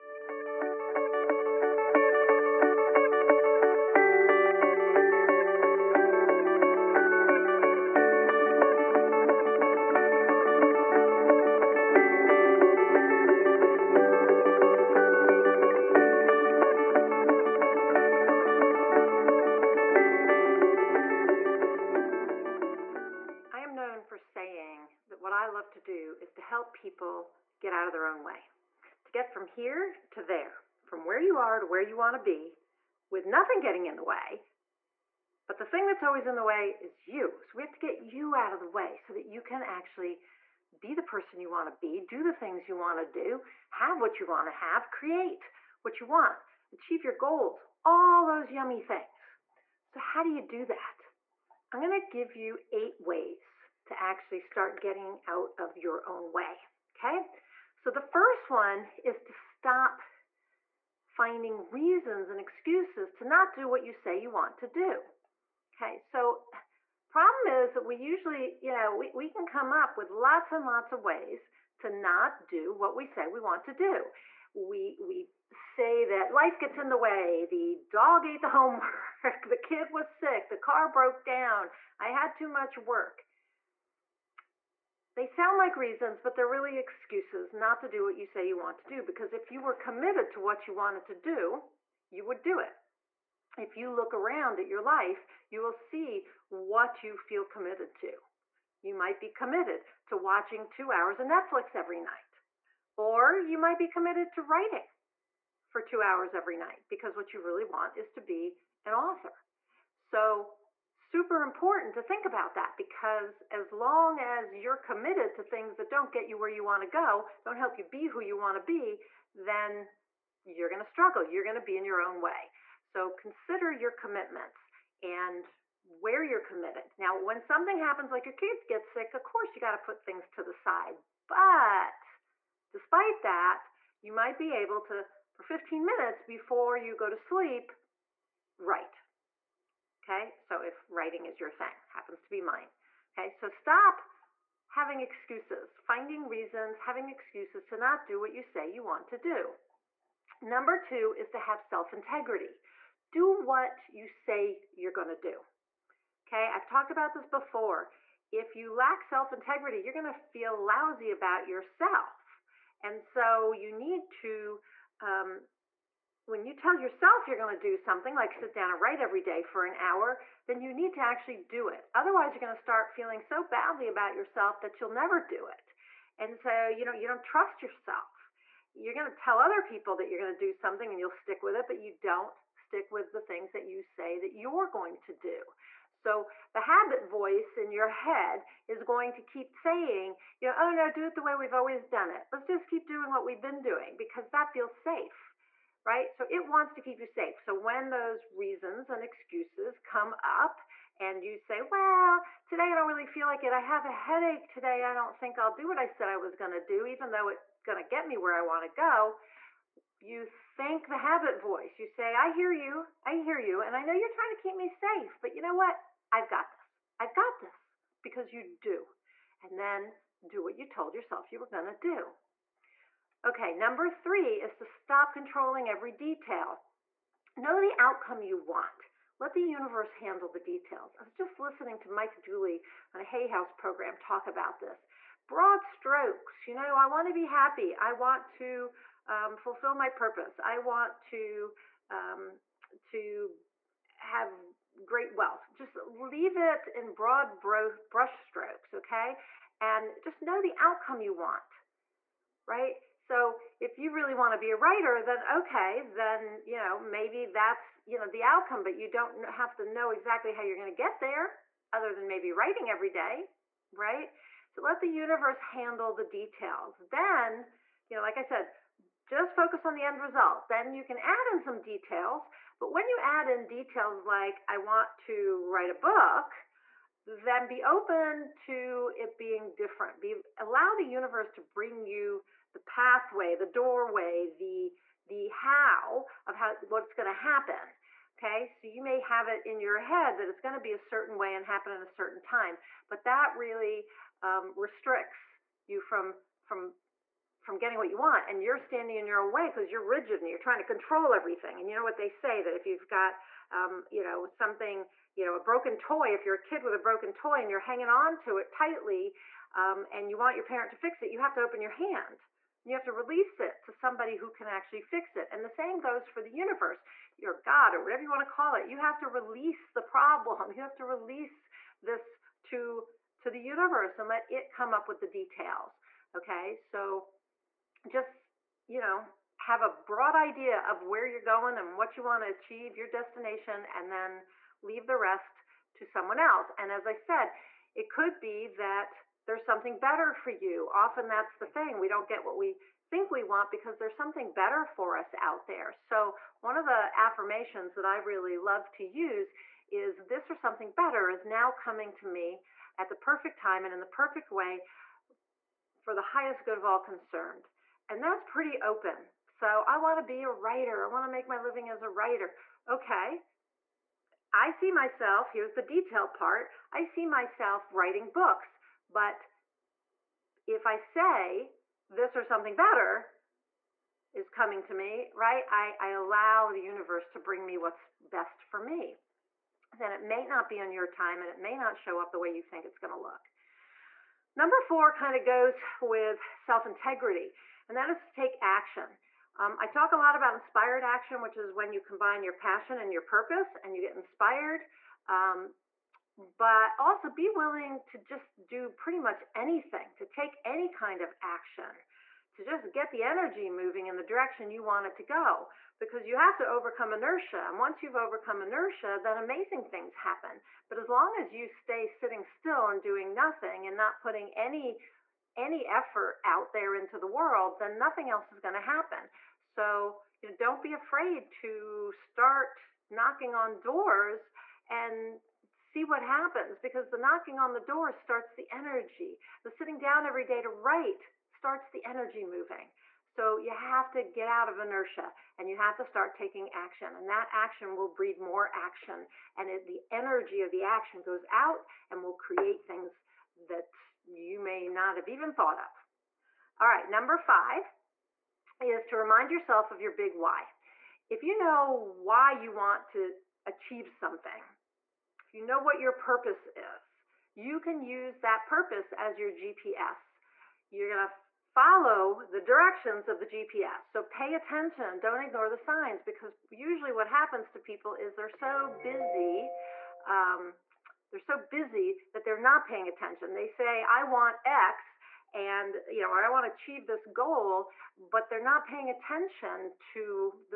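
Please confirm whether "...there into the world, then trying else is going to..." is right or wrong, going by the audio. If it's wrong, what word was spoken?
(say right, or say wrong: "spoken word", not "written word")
wrong: "nothing", not "trying".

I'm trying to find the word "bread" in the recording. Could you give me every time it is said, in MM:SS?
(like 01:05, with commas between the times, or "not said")
not said.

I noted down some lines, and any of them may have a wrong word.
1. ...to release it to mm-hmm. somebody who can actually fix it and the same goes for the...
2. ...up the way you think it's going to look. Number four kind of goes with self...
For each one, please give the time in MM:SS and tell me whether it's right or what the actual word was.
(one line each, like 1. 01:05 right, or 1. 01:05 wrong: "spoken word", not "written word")
1. 05:12 right
2. 06:21 right.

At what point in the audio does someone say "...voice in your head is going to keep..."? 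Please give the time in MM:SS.
03:07.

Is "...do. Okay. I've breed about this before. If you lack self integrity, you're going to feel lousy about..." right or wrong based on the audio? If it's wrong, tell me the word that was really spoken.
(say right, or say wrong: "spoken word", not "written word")
wrong: "talked", not "breed".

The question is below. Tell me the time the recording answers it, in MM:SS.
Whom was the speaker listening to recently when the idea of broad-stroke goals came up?
03:51.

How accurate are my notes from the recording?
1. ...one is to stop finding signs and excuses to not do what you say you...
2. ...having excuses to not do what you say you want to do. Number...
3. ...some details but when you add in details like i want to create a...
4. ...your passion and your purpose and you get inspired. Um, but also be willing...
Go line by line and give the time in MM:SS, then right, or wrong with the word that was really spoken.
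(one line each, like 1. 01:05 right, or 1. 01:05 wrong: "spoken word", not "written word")
1. 00:58 wrong: "reasons", not "signs"
2. 02:26 right
3. 04:31 wrong: "write", not "create"
4. 06:32 right.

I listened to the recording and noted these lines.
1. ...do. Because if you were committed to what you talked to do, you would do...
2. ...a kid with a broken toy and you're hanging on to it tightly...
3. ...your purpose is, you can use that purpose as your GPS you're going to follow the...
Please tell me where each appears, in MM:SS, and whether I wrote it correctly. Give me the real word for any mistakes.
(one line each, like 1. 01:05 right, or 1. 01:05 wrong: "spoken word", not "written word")
1. 01:28 wrong: "wanted", not "talked"
2. 05:06 right
3. 07:35 right.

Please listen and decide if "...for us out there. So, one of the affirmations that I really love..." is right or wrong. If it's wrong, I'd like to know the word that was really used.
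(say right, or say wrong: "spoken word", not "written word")
right.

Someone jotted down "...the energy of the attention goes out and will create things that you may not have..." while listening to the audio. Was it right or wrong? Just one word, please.
wrong.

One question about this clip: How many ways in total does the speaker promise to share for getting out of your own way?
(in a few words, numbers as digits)
8.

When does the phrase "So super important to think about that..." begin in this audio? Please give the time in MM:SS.
01:49.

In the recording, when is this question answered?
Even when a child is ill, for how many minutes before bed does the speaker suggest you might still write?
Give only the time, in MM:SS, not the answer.
02:15.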